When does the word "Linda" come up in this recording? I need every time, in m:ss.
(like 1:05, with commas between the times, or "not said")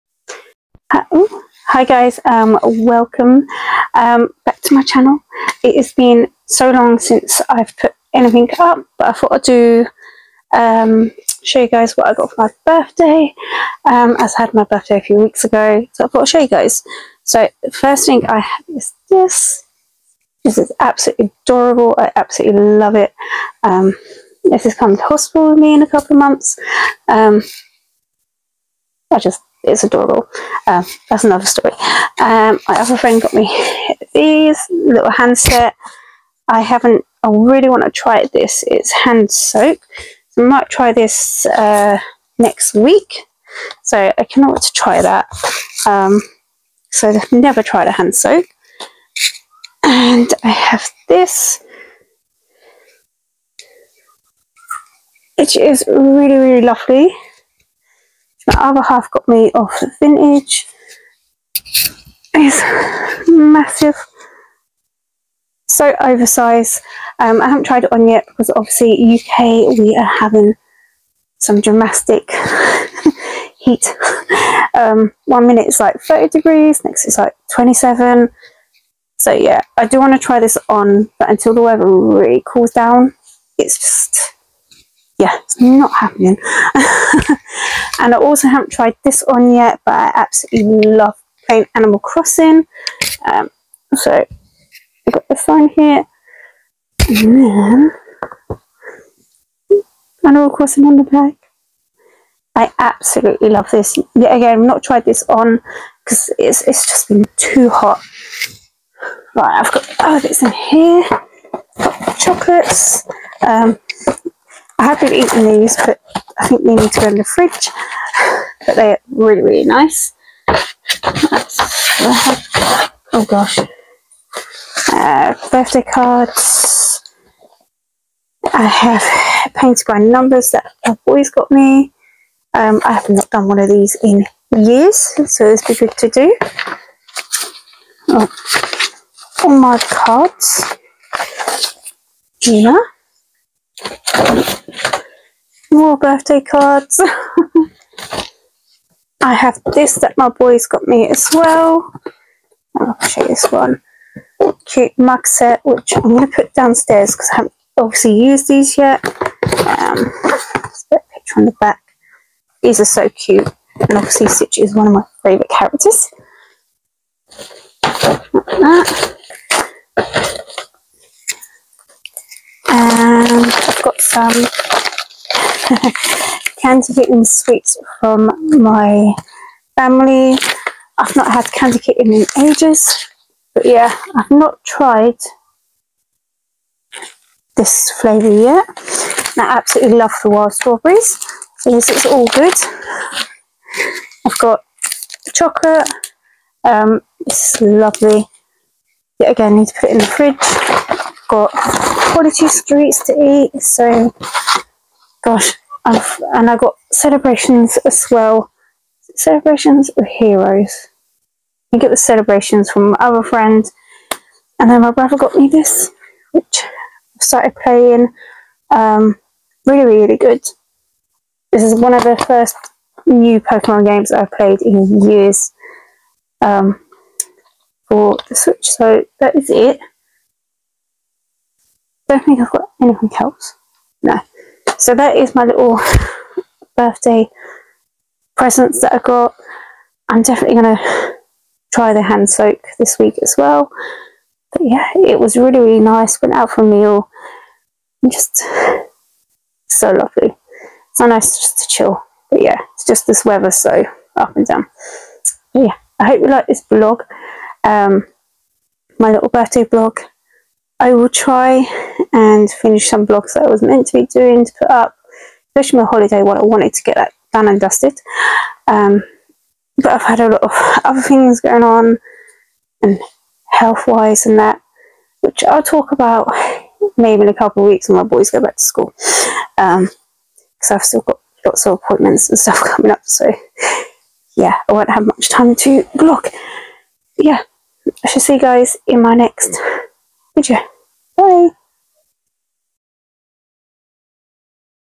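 not said.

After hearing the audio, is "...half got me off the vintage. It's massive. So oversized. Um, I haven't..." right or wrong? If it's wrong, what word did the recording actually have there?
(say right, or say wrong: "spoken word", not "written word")
right.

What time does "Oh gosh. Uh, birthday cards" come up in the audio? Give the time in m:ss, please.
2:03.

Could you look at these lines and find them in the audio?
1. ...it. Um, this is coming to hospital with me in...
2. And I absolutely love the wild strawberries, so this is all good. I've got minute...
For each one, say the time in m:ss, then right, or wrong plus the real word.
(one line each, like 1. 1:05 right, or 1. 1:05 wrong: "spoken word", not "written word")
1. 0:22 right
2. 3:09 wrong: "chocolate", not "minute".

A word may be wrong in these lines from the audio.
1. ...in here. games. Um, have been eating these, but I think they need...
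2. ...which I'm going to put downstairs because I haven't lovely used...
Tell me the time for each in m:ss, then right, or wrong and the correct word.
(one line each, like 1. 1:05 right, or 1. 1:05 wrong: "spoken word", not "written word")
1. 1:50 wrong: "chocolates", not "games"
2. 2:35 wrong: "obviously", not "lovely".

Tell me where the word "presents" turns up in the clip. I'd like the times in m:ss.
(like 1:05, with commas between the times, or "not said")
3:58.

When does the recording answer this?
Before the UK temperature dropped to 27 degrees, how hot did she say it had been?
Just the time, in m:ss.
1:16.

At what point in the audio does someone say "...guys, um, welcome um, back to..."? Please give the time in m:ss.
0:01.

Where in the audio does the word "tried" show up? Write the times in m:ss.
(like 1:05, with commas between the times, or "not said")
0:47, 1:07, 1:28, 1:44, 3:04.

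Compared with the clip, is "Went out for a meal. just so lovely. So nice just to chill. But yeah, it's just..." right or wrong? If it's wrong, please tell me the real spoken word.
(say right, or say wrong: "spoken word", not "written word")
right.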